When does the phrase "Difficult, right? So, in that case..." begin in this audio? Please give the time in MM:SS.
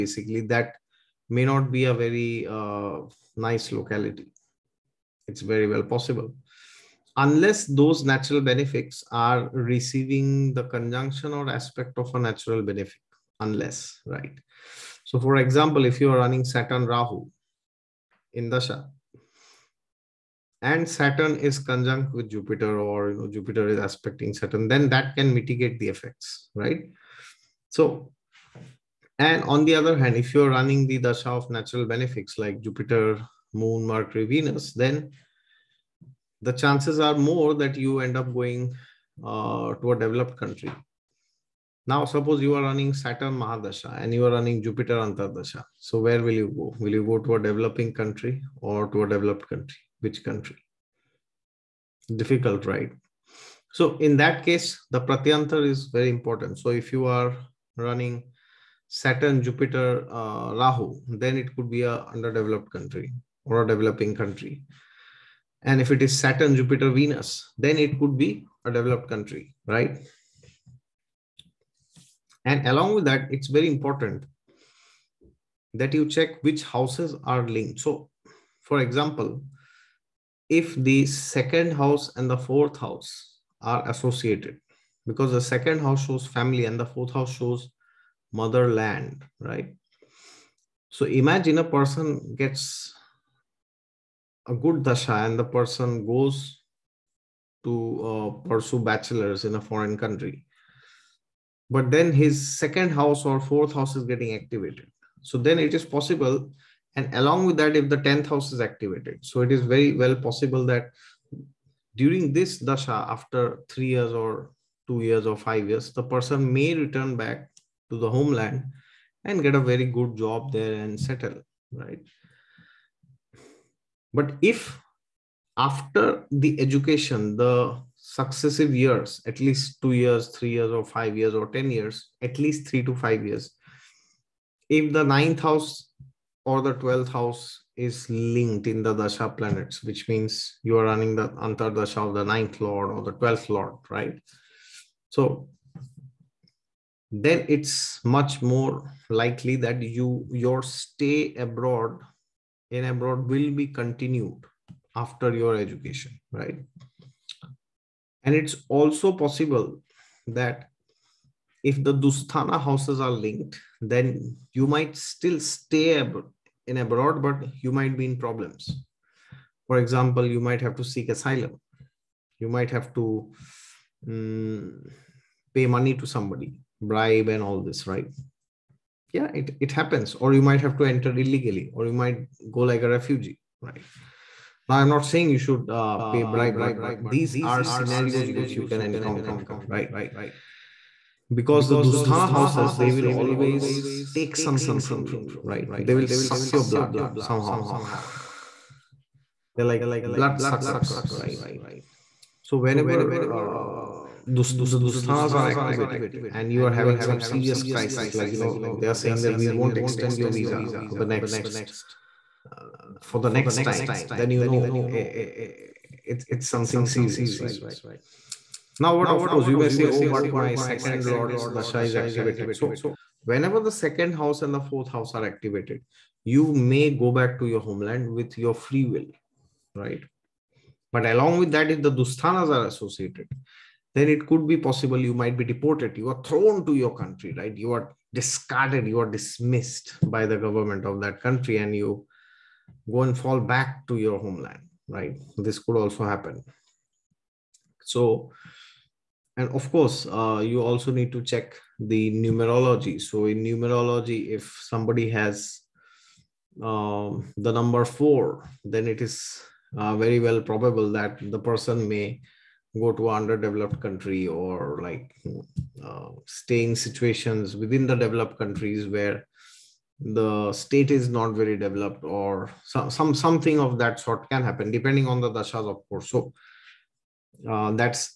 00:52.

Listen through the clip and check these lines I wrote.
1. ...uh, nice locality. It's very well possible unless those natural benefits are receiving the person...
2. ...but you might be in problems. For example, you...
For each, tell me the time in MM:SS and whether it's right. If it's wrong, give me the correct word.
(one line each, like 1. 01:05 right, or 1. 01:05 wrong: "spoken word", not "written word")
1. 00:02 wrong: "conjunction", not "person"
2. 02:47 right.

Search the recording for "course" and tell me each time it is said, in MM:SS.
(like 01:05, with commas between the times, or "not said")
03:39, 04:09, 04:35.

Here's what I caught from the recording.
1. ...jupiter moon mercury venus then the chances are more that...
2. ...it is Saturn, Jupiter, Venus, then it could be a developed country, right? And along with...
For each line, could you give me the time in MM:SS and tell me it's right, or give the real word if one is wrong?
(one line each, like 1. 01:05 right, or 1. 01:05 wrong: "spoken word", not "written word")
1. 00:32 right
2. 01:05 right.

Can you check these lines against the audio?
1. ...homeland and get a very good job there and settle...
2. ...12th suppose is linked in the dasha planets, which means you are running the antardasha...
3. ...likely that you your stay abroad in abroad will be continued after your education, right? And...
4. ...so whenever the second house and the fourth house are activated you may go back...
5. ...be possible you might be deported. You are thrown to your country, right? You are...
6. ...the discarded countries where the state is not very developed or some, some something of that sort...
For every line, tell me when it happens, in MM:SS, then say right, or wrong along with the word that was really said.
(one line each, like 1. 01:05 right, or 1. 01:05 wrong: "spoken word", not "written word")
1. 01:58 right
2. 02:16 wrong: "house", not "suppose"
3. 02:29 right
4. 03:42 right
5. 03:54 right
6. 04:27 wrong: "developed", not "discarded".